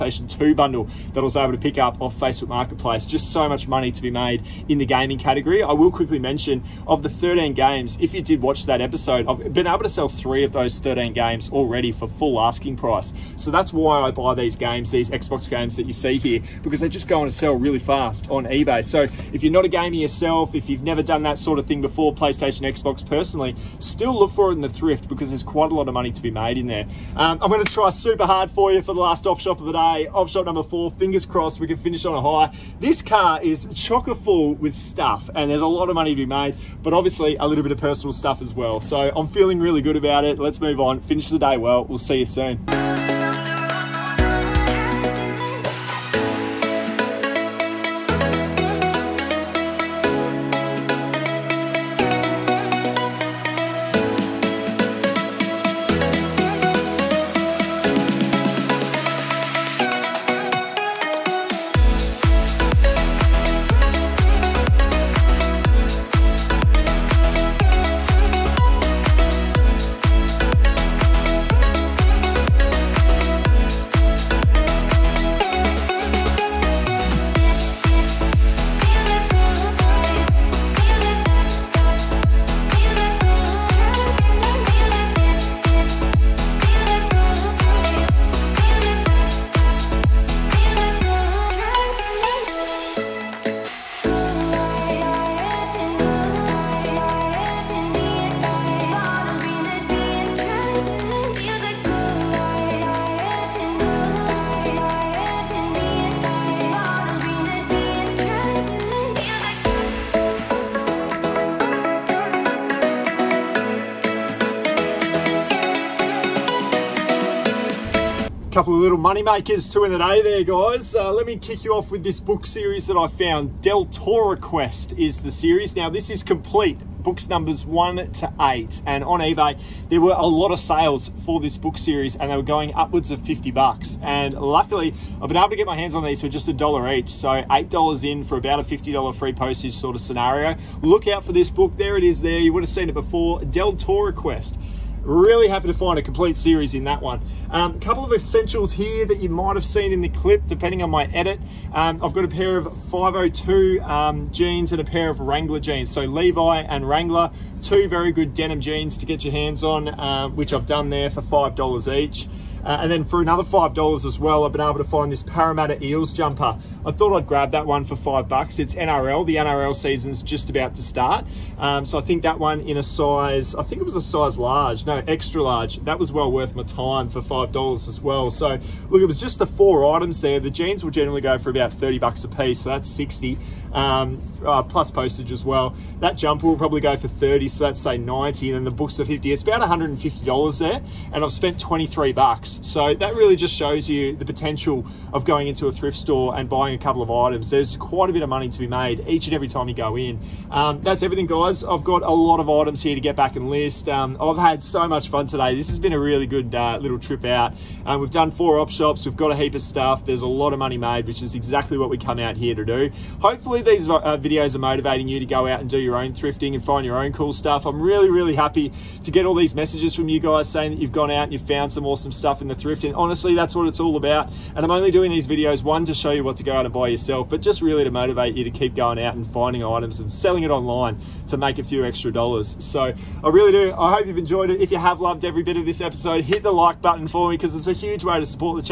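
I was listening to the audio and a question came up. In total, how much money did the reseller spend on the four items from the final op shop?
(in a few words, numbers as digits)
$23.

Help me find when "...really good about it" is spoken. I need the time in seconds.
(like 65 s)
39 s.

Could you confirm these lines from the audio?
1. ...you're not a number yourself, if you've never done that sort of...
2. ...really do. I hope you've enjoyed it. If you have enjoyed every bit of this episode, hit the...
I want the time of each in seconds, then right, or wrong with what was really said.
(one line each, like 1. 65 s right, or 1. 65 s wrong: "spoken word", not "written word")
1. 19 s wrong: "gamer", not "number"
2. 233 s wrong: "loved", not "enjoyed".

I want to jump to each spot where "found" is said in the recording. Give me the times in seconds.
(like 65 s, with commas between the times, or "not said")
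123 s, 221 s.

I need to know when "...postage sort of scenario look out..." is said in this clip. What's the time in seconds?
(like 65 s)
139 s.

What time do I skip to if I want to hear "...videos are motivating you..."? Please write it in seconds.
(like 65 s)
214 s.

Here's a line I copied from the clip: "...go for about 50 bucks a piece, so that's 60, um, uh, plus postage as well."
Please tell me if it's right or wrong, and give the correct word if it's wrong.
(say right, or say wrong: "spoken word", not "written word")
wrong: "30", not "50".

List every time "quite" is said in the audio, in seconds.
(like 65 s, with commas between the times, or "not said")
25 s, 197 s.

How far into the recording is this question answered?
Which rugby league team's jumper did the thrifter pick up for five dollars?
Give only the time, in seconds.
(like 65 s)
165 s.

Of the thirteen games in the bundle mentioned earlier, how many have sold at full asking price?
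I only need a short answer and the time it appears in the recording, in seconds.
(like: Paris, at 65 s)
3, at 10 s.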